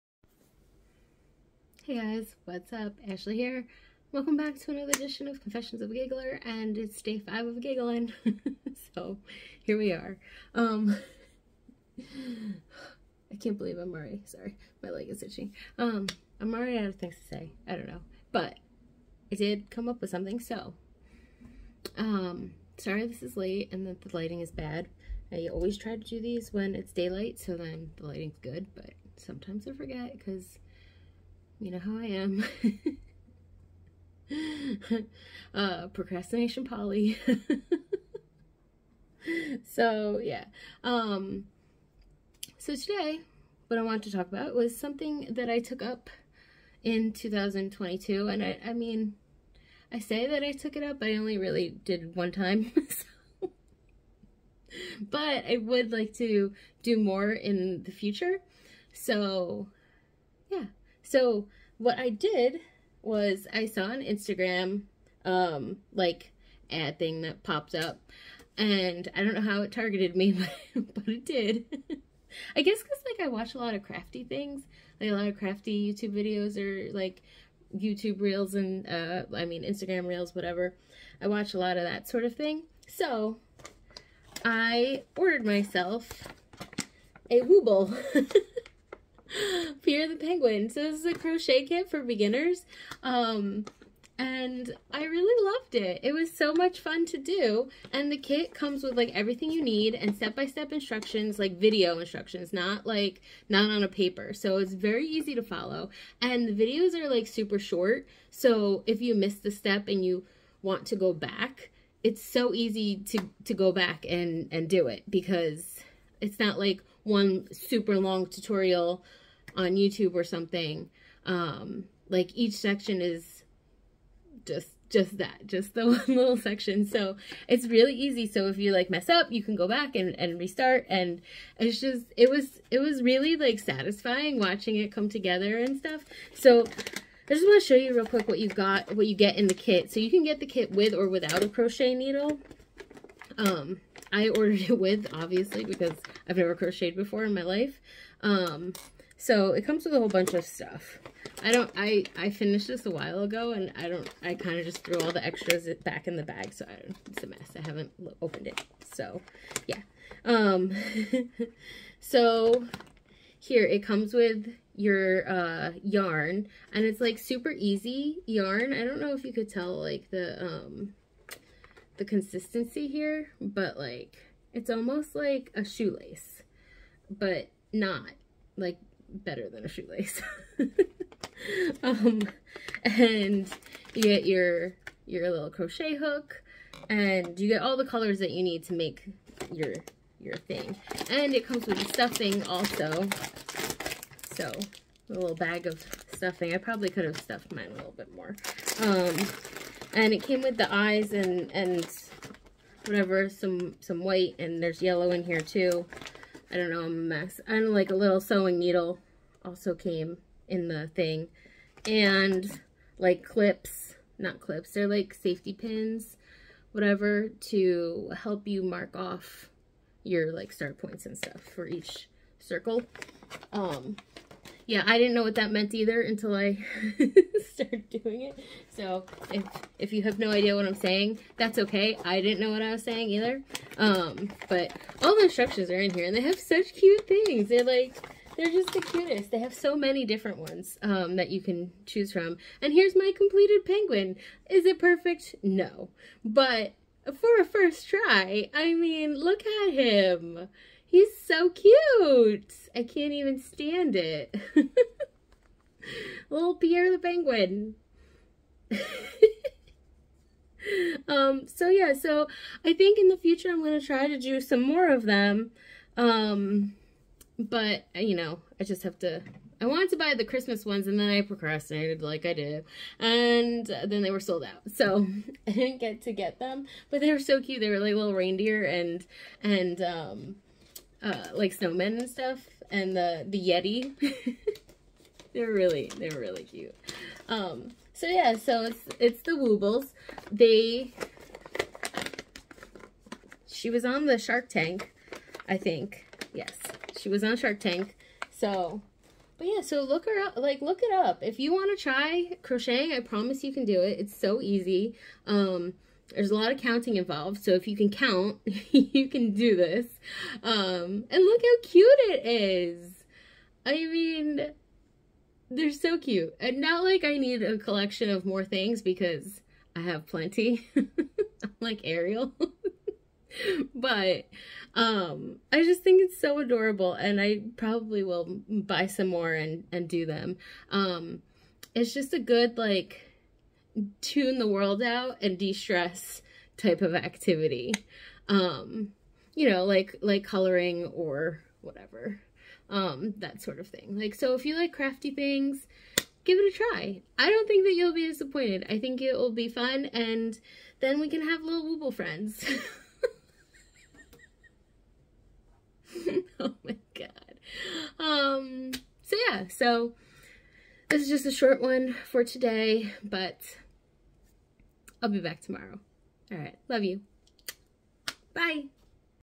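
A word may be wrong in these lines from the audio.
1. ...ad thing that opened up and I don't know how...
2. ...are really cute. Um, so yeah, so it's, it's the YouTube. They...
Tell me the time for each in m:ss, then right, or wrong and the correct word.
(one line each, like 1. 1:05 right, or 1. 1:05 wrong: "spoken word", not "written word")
1. 1:06 wrong: "popped", not "opened"
2. 4:46 wrong: "Woobles", not "YouTube".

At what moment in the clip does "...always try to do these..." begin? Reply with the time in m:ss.
0:25.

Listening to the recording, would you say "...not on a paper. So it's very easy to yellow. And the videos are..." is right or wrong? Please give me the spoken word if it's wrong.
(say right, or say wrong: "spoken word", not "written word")
wrong: "follow", not "yellow".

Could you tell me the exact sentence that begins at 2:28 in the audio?
Um, so it comes with a whole bunch of stuff.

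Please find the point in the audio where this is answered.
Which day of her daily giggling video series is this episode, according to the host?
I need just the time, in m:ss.
0:07.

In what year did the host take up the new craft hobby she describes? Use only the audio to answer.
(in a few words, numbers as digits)
2022.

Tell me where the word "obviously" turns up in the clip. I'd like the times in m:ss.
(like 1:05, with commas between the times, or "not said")
2:25.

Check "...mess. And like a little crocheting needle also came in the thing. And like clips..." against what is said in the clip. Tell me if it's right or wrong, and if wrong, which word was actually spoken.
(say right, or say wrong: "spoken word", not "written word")
wrong: "sewing", not "crocheting".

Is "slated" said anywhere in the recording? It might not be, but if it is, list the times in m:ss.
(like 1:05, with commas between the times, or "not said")
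not said.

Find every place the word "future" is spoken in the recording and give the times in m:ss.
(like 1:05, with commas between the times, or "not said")
0:57, 4:23.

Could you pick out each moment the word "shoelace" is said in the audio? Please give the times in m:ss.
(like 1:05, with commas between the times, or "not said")
2:55, 2:59.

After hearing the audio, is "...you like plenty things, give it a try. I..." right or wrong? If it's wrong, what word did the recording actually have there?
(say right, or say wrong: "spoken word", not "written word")
wrong: "crafty", not "plenty".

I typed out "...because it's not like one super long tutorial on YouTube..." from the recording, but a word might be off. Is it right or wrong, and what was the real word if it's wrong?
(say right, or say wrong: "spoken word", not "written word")
right.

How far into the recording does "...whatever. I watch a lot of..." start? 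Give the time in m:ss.
1:20.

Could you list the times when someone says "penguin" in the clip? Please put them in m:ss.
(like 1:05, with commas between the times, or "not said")
1:30, 4:03, 4:16.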